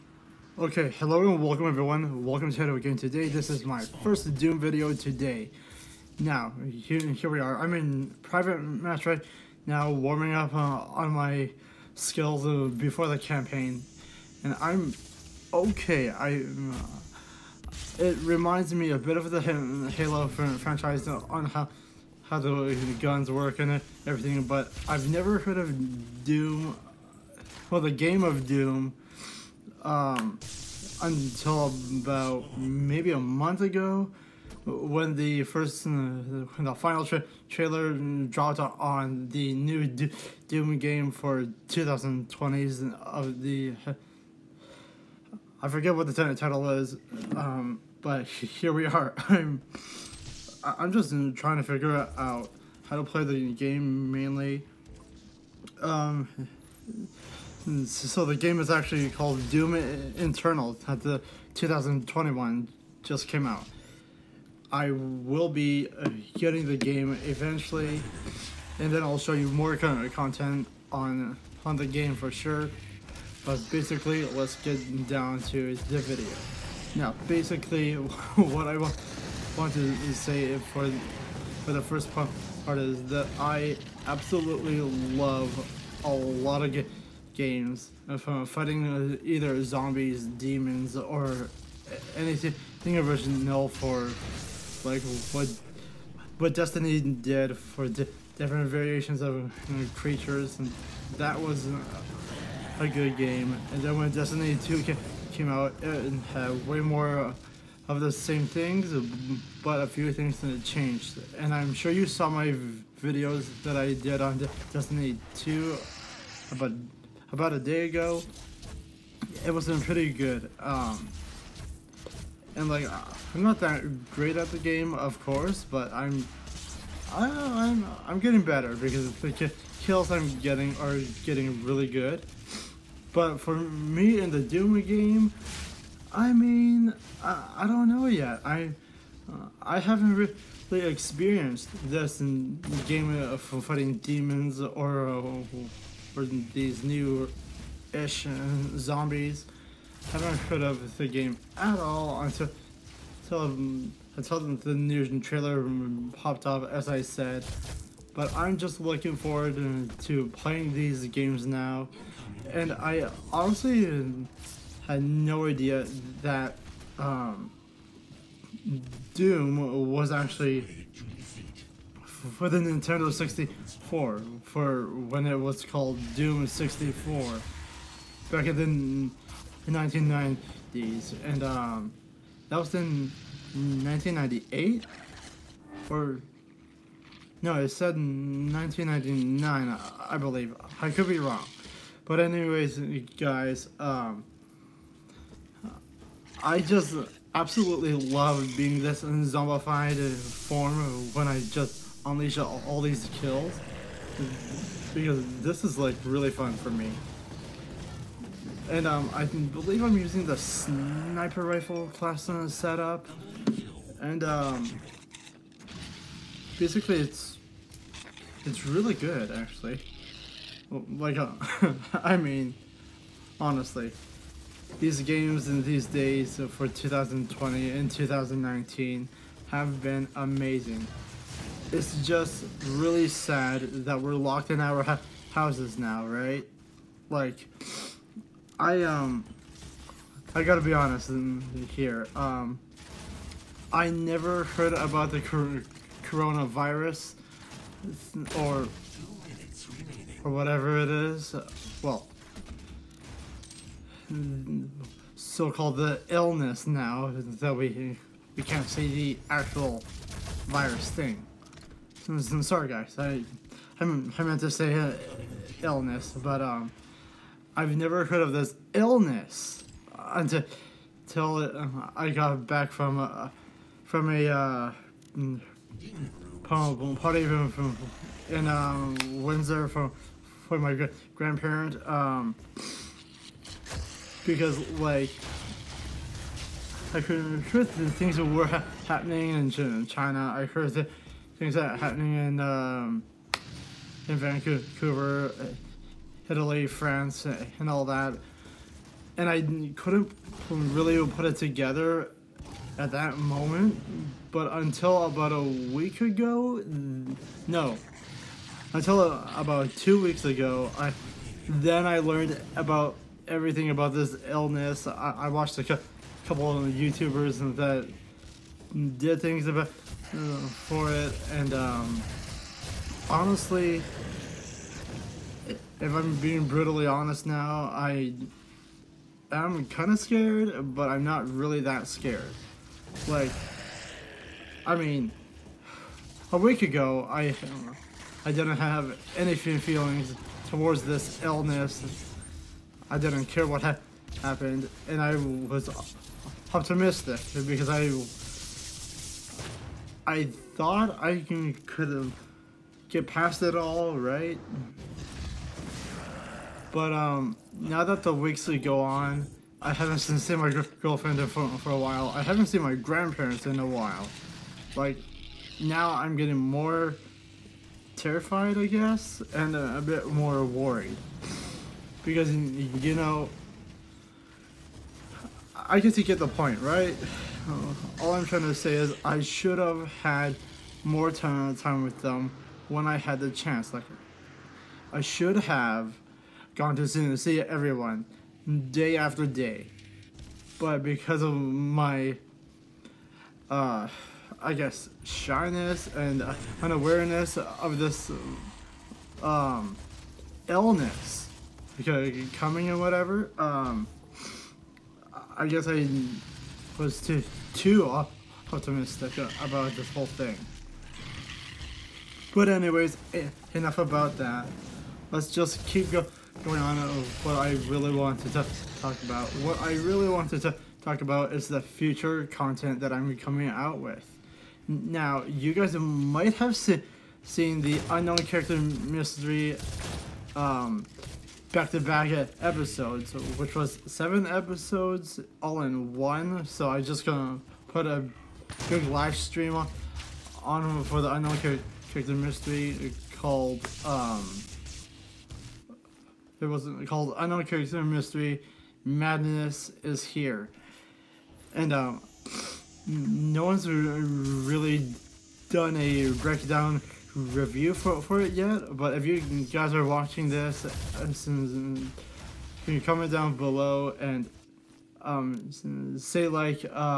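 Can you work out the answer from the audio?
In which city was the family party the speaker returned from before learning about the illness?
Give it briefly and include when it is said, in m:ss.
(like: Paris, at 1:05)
Windsor, at 4:39.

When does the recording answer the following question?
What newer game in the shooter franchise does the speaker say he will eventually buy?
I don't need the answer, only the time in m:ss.
0:59.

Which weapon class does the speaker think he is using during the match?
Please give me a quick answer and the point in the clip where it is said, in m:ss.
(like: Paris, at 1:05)
Sniper rifle, at 3:30.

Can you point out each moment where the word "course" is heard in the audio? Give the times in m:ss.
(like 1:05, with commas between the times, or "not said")
2:05.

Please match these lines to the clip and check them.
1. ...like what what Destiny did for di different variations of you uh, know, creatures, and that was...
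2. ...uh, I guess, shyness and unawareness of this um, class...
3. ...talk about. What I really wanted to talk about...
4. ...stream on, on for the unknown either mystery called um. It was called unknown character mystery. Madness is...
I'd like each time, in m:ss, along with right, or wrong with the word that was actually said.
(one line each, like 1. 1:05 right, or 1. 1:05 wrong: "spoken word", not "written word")
1. 1:34 right
2. 6:33 wrong: "illness", not "class"
3. 6:58 right
4. 7:19 wrong: "character", not "either".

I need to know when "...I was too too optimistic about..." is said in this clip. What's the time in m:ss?
6:45.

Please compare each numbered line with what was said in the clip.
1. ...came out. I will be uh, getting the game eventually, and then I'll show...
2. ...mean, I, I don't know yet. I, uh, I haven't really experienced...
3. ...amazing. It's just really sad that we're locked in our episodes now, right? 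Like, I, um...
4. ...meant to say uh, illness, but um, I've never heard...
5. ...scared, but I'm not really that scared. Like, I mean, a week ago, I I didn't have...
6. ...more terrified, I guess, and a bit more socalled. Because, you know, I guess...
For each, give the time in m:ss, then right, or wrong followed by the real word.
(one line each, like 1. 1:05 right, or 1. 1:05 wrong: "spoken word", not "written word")
1. 1:03 right
2. 2:16 right
3. 3:50 wrong: "houses", not "episodes"
4. 4:23 right
5. 5:30 right
6. 6:06 wrong: "worried", not "socalled".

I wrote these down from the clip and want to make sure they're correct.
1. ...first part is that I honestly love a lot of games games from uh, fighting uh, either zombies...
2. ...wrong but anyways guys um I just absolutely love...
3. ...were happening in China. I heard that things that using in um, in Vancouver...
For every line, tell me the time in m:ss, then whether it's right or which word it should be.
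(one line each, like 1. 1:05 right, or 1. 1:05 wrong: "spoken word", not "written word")
1. 1:21 wrong: "absolutely", not "honestly"
2. 3:11 right
3. 4:48 wrong: "happening", not "using".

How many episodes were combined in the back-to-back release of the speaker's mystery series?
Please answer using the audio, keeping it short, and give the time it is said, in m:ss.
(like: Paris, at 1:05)
7, at 7:13.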